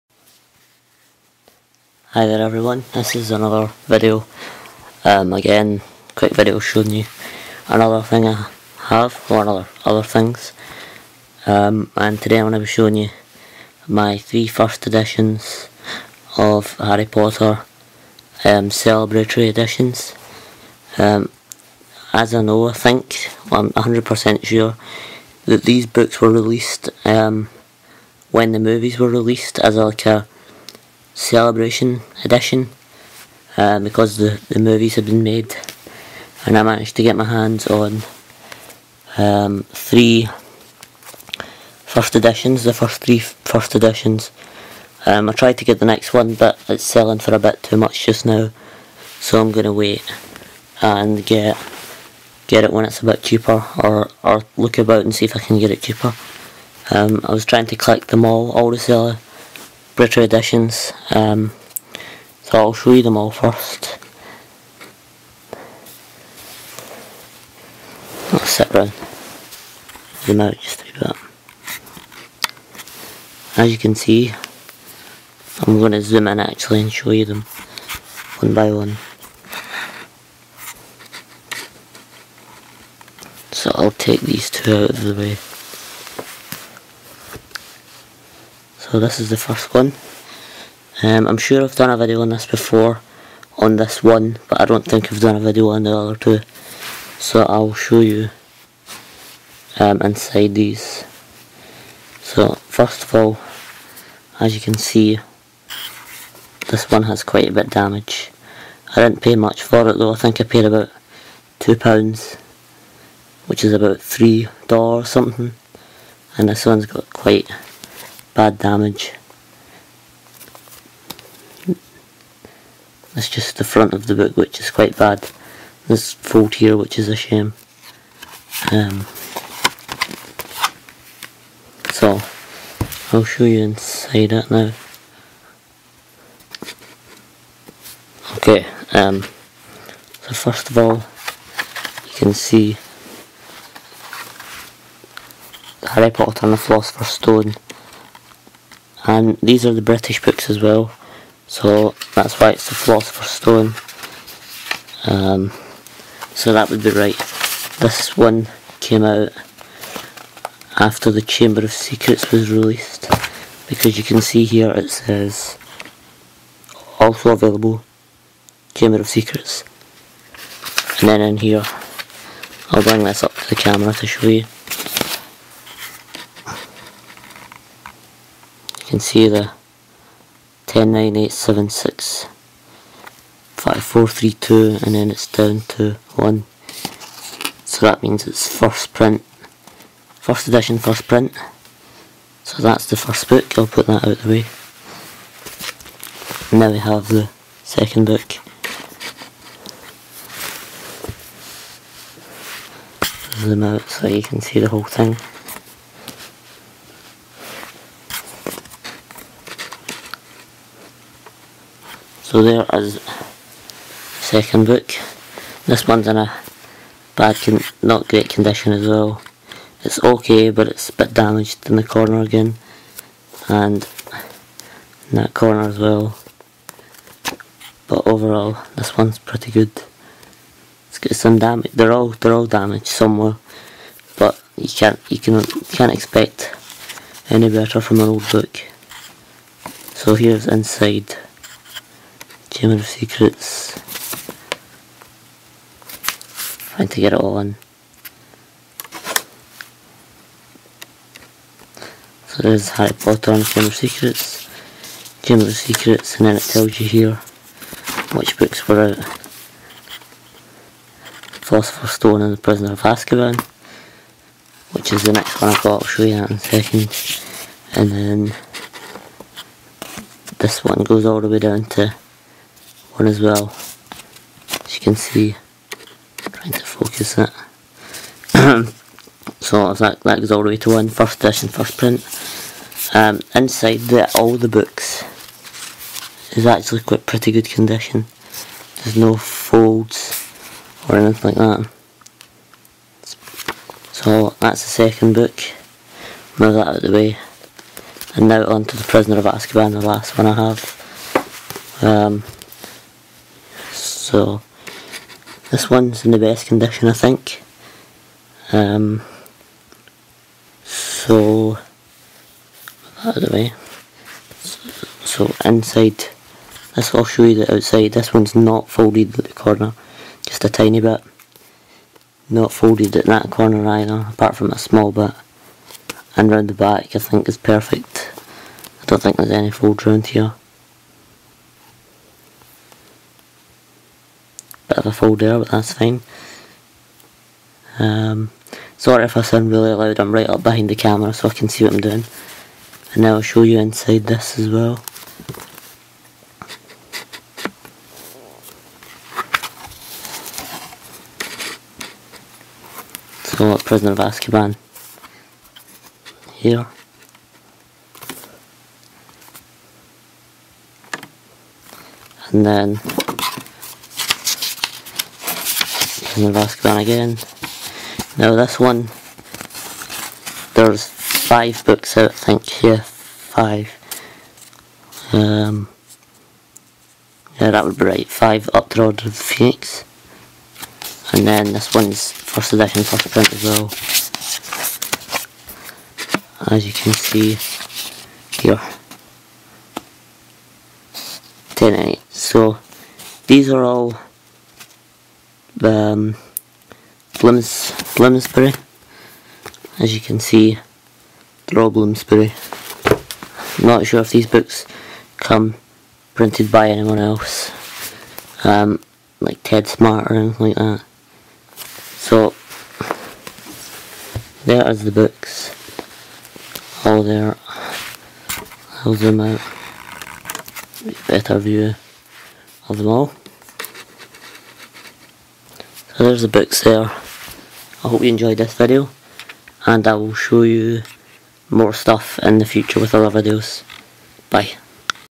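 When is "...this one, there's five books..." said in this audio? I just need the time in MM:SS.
06:08.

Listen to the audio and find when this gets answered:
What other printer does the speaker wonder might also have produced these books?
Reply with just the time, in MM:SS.
06:49.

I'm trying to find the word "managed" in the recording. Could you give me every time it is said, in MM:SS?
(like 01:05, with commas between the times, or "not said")
00:36.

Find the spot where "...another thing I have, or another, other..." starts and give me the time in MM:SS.
00:07.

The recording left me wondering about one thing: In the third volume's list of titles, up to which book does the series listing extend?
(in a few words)
Order of the Phoenix.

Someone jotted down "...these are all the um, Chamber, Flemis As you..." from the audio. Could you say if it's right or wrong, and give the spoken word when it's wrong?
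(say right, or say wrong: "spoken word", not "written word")
wrong: "Flemis", not "Chamber".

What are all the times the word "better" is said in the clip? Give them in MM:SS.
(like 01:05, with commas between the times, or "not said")
03:57, 07:01.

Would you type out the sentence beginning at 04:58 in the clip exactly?
And now on to The Prisoner of Azkaban, the last one I have.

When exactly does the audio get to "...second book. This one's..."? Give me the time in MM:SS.
03:34.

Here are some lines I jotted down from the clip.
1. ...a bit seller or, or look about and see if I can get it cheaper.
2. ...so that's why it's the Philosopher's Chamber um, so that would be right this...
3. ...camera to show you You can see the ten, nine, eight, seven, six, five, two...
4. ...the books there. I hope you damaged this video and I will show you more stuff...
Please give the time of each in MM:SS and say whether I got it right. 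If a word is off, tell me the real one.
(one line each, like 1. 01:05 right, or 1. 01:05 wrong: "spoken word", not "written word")
1. 00:53 wrong: "cheaper", not "seller"
2. 02:31 wrong: "Stone", not "Chamber"
3. 02:53 wrong: "four", not "two"
4. 07:06 wrong: "enjoyed", not "damaged".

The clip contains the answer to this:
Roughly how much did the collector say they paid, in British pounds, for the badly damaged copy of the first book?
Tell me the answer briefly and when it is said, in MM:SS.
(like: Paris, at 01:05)
£2, at 01:51.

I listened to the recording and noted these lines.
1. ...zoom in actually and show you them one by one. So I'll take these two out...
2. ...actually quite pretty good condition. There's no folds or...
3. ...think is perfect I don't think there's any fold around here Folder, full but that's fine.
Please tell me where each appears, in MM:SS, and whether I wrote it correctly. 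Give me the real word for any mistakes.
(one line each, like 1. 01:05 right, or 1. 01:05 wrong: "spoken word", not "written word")
1. 01:16 right
2. 04:46 right
3. 05:26 right.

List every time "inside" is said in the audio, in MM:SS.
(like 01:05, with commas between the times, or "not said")
01:40, 02:13, 04:00, 04:43, 05:15, 05:43.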